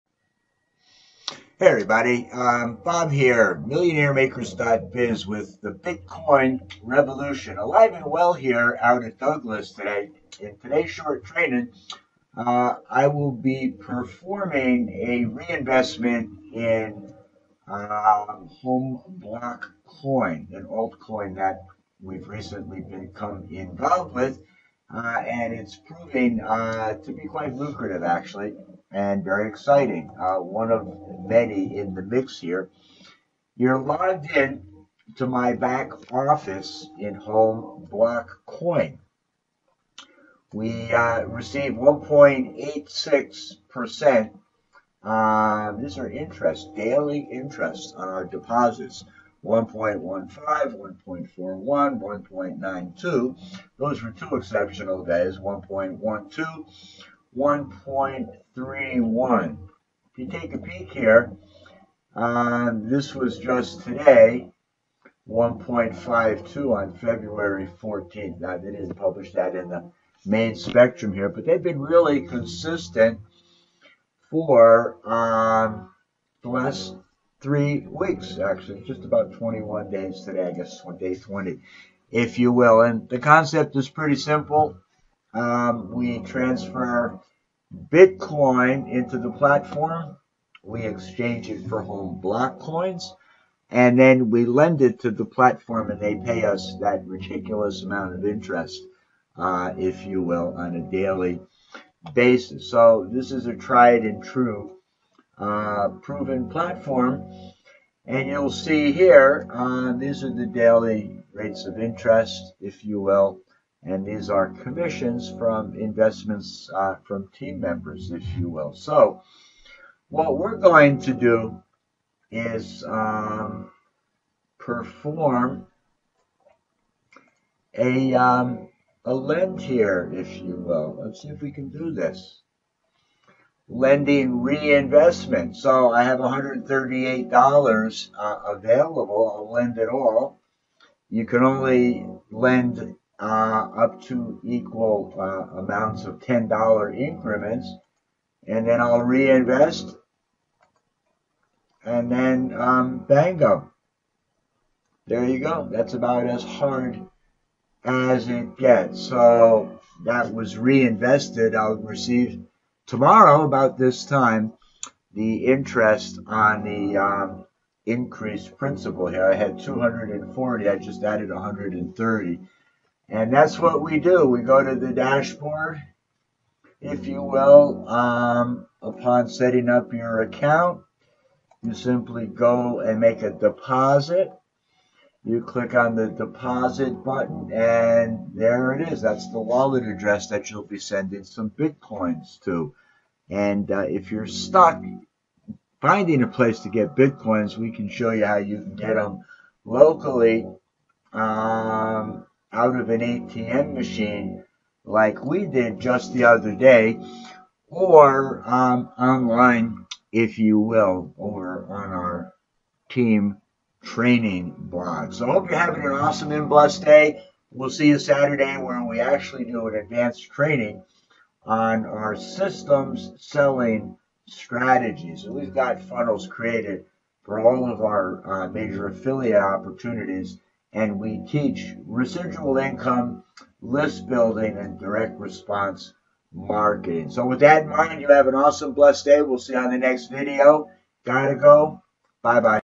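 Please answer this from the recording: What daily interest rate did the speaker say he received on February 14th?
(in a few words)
1.52.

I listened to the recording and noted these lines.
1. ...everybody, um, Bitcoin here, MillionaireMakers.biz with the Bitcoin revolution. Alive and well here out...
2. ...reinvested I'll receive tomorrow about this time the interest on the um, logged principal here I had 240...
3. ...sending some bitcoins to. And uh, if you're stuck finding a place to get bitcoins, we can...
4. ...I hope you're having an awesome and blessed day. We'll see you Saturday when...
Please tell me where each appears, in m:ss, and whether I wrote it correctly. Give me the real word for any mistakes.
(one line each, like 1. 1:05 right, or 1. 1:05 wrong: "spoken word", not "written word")
1. 0:01 wrong: "Bob", not "Bitcoin"
2. 2:40 wrong: "increased", not "logged"
3. 3:10 right
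4. 3:35 right.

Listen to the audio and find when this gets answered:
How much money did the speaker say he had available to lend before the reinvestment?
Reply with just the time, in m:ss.
2:16.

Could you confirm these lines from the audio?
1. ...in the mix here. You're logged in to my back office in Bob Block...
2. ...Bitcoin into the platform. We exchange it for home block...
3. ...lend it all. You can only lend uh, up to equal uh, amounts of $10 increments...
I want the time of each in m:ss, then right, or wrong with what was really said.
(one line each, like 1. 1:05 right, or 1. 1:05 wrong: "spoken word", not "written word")
1. 0:31 wrong: "Home", not "Bob"
2. 1:27 right
3. 2:19 right.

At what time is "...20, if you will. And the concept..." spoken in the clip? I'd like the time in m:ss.
1:21.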